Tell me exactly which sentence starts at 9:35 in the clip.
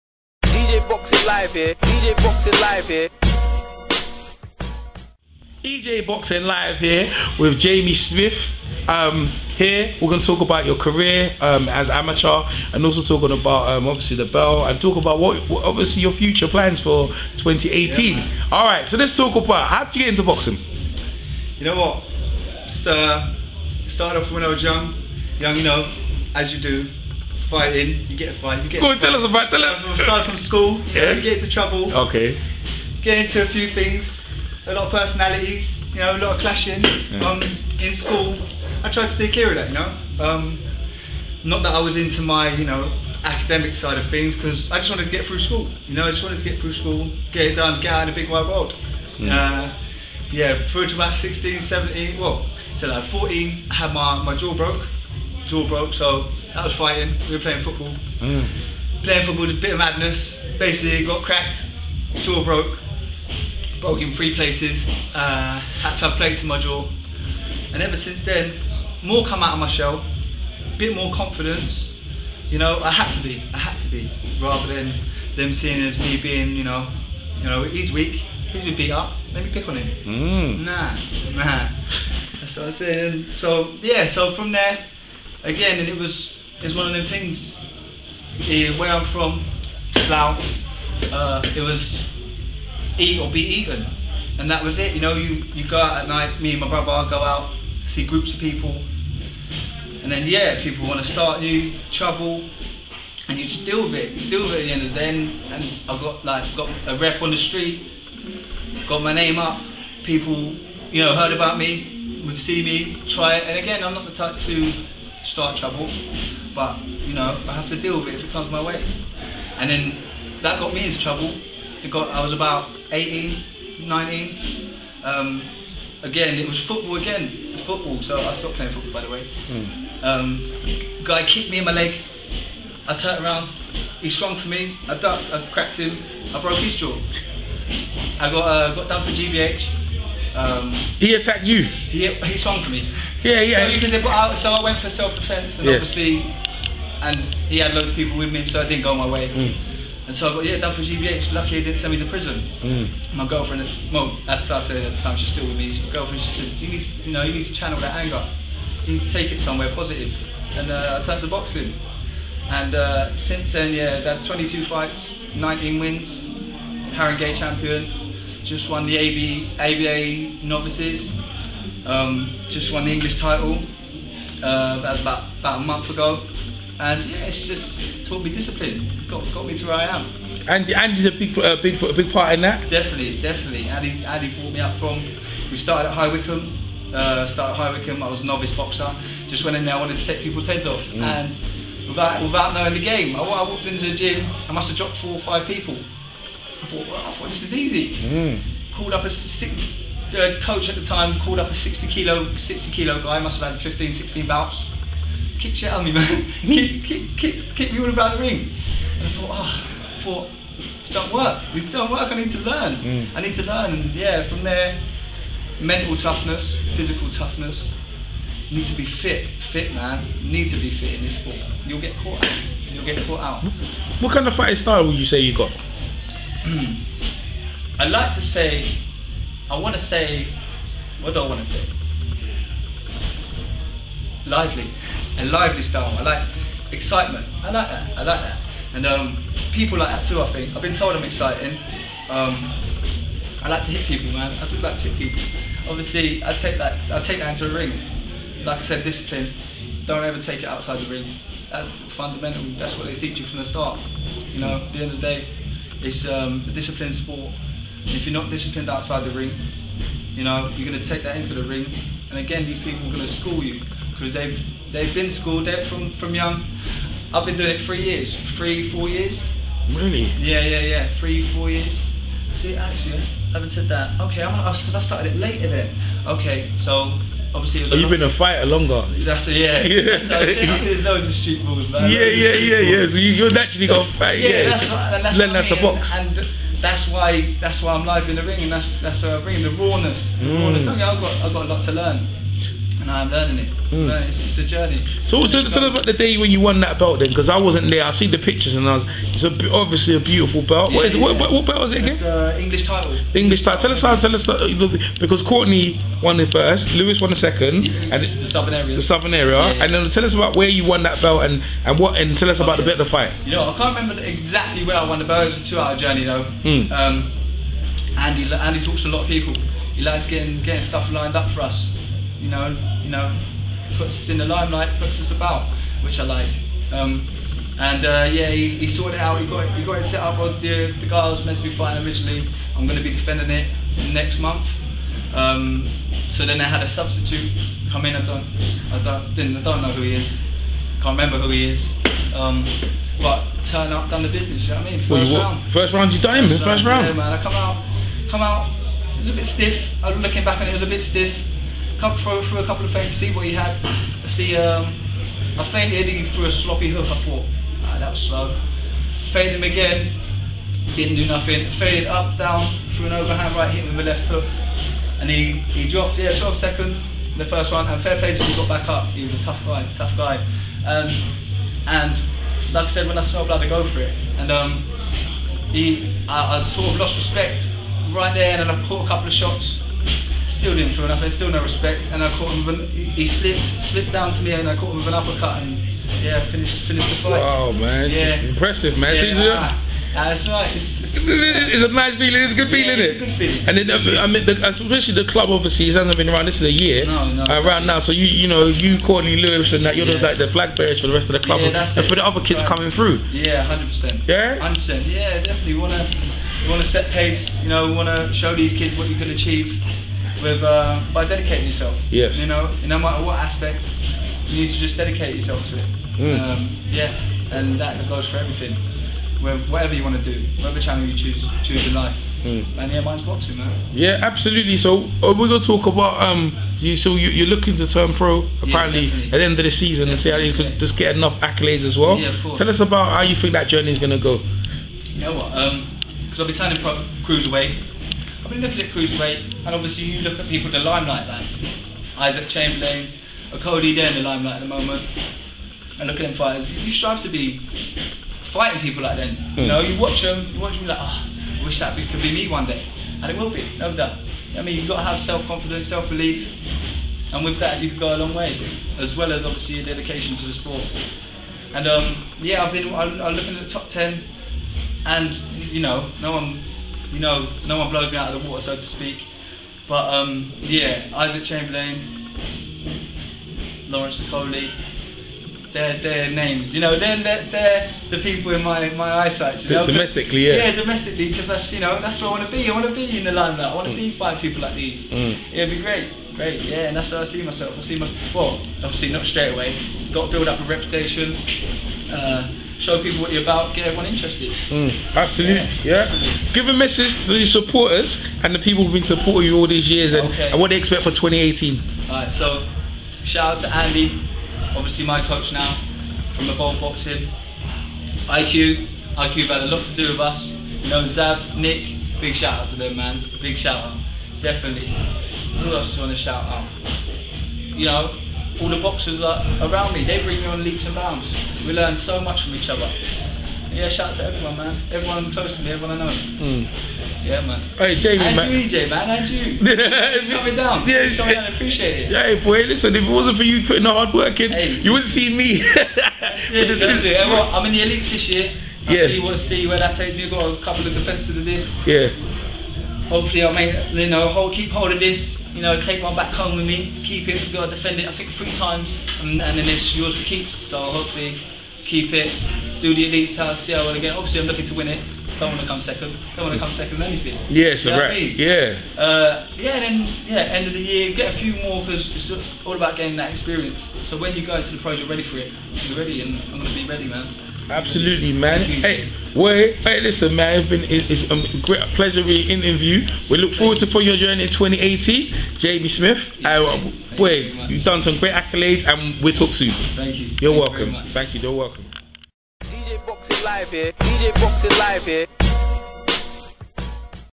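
Jamie Smith, uh, boy, you've done some great accolades, and we'll talk soon.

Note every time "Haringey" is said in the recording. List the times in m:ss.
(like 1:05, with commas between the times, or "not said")
2:46.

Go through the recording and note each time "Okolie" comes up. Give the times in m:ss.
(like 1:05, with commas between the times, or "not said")
7:23, 7:54.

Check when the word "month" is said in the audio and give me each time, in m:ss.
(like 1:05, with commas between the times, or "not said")
2:55, 5:34.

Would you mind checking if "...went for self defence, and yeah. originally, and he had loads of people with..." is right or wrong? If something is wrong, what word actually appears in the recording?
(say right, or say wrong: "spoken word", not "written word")
wrong: "obviously", not "originally".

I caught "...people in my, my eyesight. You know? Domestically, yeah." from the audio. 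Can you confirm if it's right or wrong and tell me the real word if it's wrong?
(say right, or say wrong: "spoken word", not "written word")
right.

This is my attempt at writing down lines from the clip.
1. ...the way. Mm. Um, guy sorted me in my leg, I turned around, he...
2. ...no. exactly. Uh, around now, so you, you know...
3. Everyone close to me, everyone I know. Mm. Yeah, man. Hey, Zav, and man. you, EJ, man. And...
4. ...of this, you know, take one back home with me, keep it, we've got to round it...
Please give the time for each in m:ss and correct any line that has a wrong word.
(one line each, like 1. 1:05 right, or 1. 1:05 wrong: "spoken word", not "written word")
1. 2:09 wrong: "kicked", not "sorted"
2. 6:37 right
3. 8:44 wrong: "Jamie", not "Zav"
4. 9:04 wrong: "defend", not "round".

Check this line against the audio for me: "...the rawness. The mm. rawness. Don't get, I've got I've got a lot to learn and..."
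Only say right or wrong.
right.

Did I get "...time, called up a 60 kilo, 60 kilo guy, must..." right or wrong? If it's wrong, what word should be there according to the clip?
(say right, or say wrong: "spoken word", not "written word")
right.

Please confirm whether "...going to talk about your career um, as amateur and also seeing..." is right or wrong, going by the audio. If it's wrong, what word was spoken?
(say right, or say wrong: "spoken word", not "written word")
wrong: "talking", not "seeing".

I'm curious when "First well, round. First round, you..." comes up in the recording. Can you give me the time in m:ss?
5:44.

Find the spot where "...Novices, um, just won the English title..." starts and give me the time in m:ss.
2:50.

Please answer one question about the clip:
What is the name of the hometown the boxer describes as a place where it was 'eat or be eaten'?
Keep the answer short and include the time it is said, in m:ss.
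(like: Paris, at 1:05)
Slough, at 1:30.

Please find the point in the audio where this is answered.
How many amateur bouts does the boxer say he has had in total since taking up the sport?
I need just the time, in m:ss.
2:44.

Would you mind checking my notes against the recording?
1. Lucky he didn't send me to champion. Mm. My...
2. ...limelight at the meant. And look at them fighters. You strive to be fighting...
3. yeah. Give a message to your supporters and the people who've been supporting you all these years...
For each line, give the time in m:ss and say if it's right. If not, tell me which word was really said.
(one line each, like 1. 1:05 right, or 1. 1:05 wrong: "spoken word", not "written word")
1. 2:31 wrong: "prison", not "champion"
2. 7:24 wrong: "moment", not "meant"
3. 8:15 right.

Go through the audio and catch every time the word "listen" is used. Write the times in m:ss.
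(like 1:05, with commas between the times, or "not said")
8:52, 9:29.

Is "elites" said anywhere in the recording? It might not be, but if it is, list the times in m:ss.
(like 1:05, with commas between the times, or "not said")
8:57, 9:12.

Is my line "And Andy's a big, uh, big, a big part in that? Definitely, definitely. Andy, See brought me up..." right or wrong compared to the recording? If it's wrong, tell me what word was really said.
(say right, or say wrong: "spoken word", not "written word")
wrong: "Andy", not "See".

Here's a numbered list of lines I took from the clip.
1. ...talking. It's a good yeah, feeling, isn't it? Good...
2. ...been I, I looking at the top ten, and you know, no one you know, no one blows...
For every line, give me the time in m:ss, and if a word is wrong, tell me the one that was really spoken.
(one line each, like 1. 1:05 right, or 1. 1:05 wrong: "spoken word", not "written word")
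1. 6:31 wrong: "feeling", not "talking"
2. 7:42 right.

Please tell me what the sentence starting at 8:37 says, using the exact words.
You know, all the boxers are around me.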